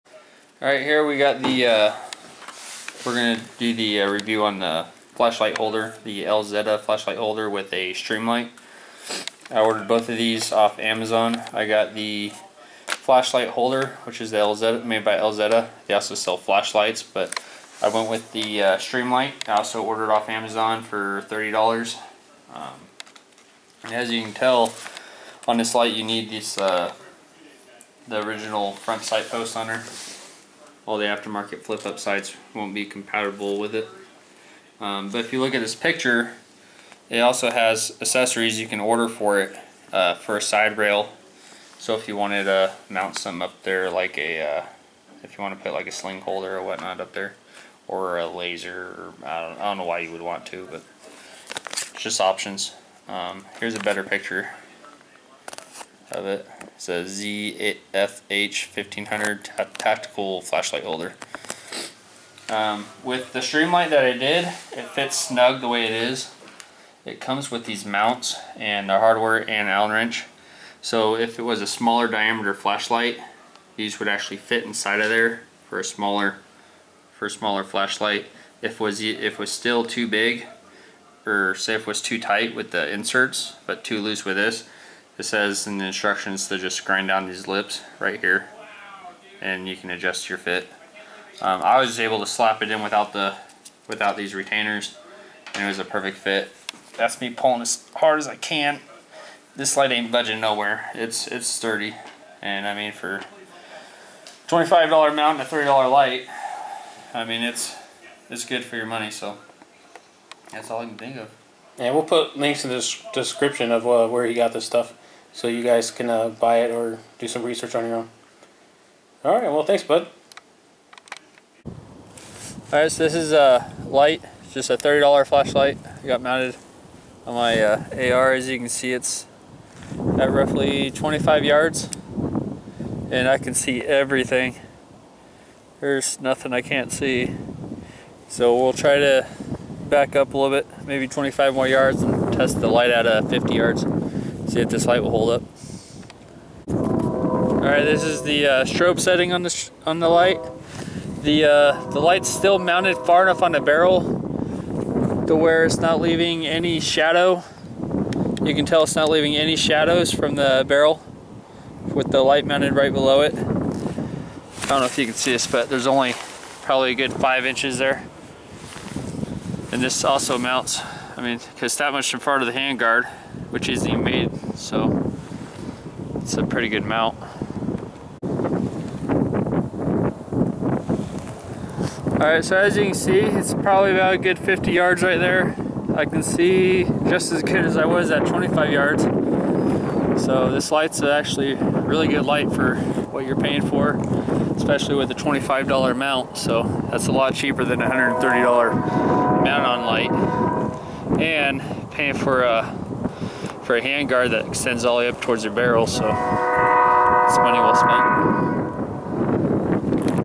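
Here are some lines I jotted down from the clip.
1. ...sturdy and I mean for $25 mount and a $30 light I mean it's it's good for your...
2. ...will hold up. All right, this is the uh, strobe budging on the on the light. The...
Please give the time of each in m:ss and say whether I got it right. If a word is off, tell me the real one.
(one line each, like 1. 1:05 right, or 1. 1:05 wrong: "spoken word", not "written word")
1. 1:41 right
2. 2:25 wrong: "setting", not "budging".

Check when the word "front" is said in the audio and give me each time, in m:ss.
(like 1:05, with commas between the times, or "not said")
0:28, 2:52.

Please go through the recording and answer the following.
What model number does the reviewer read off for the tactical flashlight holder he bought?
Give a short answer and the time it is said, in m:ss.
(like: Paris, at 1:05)
ZFH1500, at 0:57.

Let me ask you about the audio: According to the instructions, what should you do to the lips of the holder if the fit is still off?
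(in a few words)
grind down.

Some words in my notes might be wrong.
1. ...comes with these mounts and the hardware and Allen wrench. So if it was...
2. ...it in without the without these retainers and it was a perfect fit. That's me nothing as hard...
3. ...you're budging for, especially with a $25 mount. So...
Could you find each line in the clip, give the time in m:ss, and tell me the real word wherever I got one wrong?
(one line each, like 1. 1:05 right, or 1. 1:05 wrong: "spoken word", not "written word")
1. 1:07 right
2. 1:32 wrong: "pulling", not "nothing"
3. 3:13 wrong: "paying", not "budging".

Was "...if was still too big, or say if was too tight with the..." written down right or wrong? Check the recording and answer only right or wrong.
right.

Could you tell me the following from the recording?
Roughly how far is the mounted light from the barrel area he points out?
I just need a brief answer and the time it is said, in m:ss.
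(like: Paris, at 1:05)
5 inches, at 2:47.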